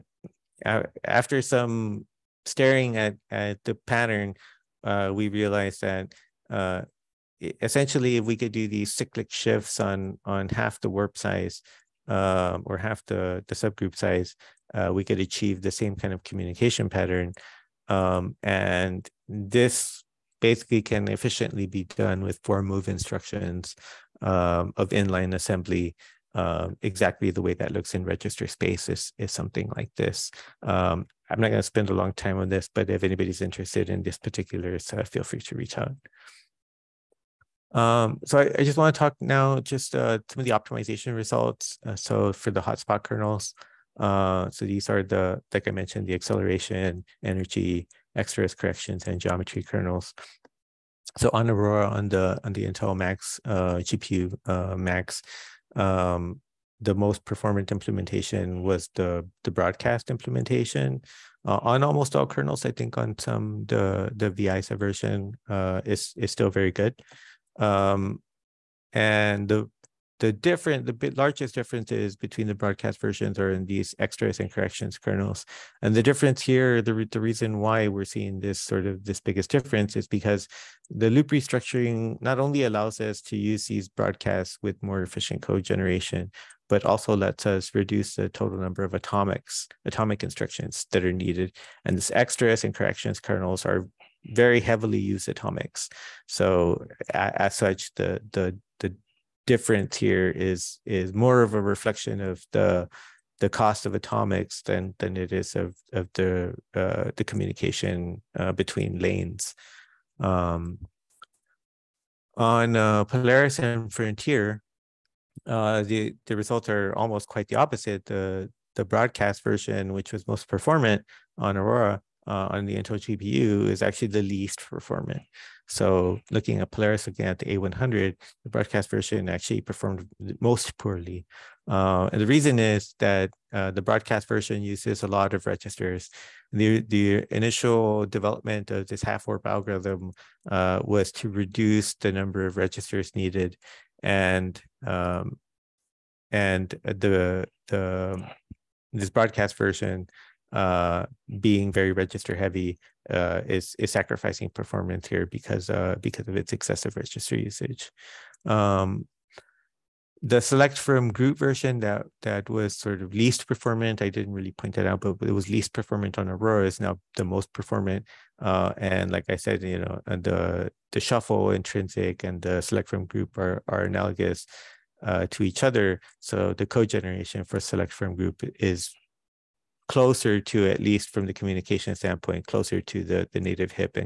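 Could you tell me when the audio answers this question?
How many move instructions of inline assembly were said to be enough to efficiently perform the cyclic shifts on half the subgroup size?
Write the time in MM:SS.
00:22.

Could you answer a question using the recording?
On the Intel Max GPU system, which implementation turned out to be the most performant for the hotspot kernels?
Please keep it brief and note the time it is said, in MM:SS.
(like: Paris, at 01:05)
Broadcast implementation, at 00:59.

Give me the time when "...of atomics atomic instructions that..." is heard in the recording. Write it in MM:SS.
01:28.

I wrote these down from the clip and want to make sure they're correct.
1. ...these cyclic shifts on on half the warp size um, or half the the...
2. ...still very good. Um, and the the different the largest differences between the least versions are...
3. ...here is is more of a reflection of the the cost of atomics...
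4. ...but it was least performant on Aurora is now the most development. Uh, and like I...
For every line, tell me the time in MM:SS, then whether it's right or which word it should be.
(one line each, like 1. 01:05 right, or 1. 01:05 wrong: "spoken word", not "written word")
1. 00:08 right
2. 01:06 wrong: "broadcast", not "least"
3. 01:39 right
4. 02:45 wrong: "performant", not "development".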